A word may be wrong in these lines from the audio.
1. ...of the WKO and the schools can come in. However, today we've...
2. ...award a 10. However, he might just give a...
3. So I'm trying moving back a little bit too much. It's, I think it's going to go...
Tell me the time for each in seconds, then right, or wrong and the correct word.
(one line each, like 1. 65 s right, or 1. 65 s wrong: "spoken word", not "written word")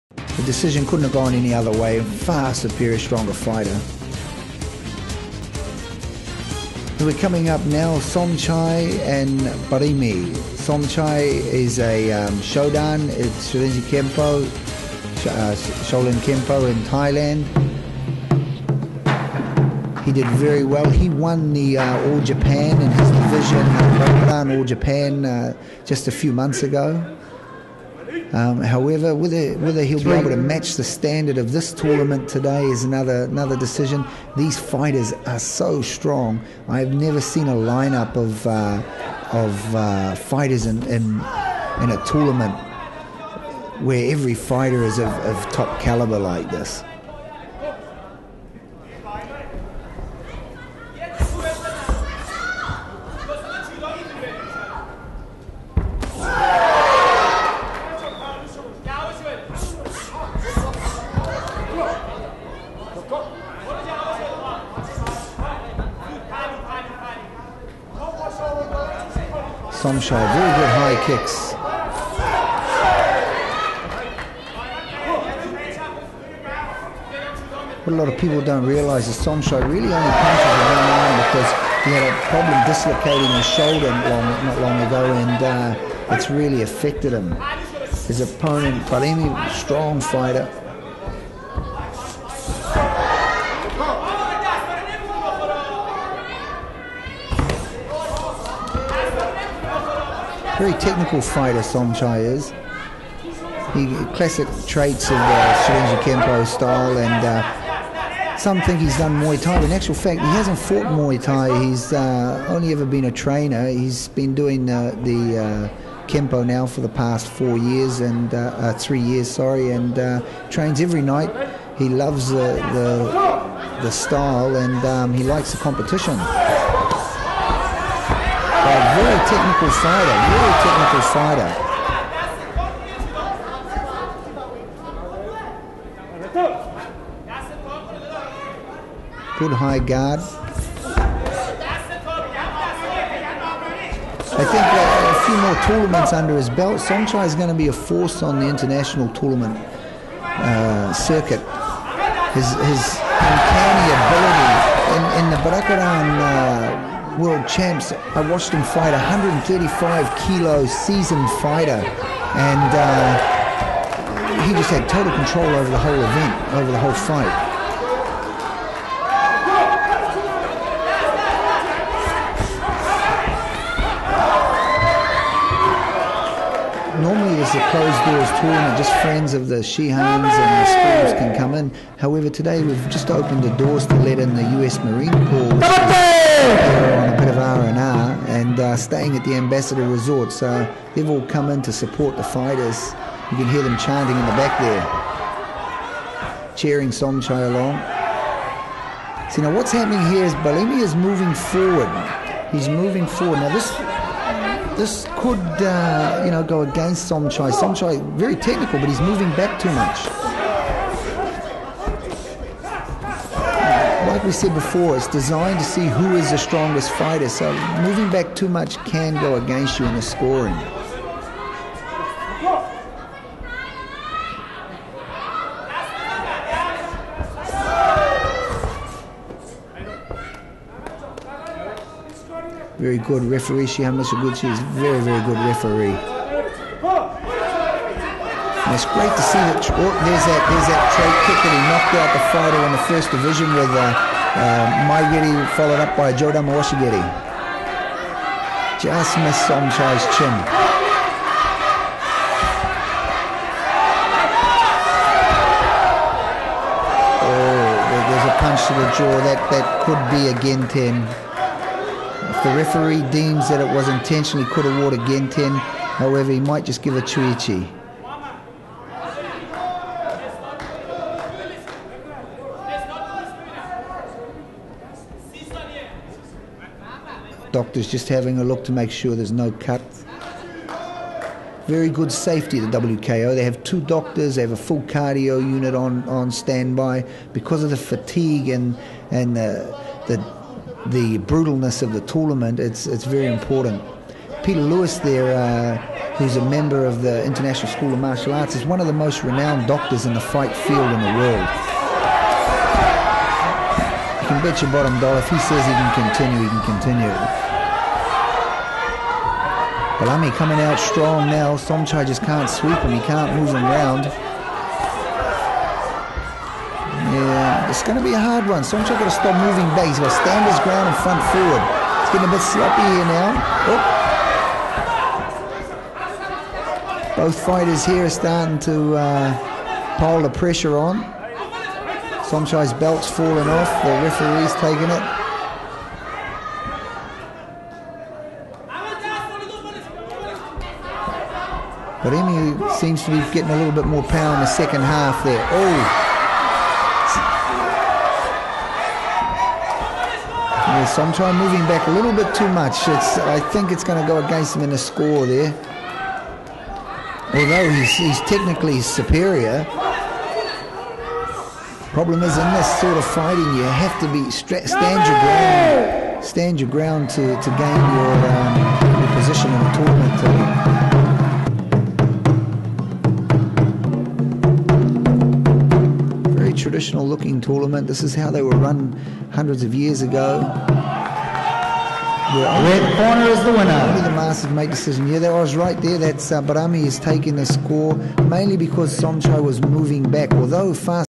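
1. 179 s wrong: "Shihans", not "WKO"
2. 264 s right
3. 350 s right.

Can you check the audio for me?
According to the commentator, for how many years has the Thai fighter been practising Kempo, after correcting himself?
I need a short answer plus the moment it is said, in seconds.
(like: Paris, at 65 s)
3 years, at 118 s.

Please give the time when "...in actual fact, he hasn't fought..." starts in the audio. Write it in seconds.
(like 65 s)
109 s.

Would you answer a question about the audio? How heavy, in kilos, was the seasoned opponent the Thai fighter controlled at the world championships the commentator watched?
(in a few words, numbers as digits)
135.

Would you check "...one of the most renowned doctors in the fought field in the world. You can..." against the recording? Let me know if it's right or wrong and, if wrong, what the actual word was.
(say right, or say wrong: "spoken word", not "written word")
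wrong: "fight", not "fought".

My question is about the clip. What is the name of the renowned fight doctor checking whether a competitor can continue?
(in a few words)
Peter Lewis.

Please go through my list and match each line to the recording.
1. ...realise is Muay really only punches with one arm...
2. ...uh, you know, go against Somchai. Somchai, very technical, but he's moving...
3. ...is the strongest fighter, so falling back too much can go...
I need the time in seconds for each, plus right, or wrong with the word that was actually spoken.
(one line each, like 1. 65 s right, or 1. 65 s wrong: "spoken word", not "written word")
1. 78 s wrong: "Somchai", not "Muay"
2. 205 s right
3. 216 s wrong: "moving", not "falling".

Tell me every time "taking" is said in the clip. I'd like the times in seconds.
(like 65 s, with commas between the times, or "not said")
334 s, 386 s.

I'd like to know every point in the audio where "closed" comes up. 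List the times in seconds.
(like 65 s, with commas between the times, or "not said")
177 s.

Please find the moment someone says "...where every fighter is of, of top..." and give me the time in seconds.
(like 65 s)
43 s.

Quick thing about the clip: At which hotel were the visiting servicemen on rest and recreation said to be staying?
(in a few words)
Ambassador Resort.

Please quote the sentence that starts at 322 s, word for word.
It's getting a bit sloppy here now.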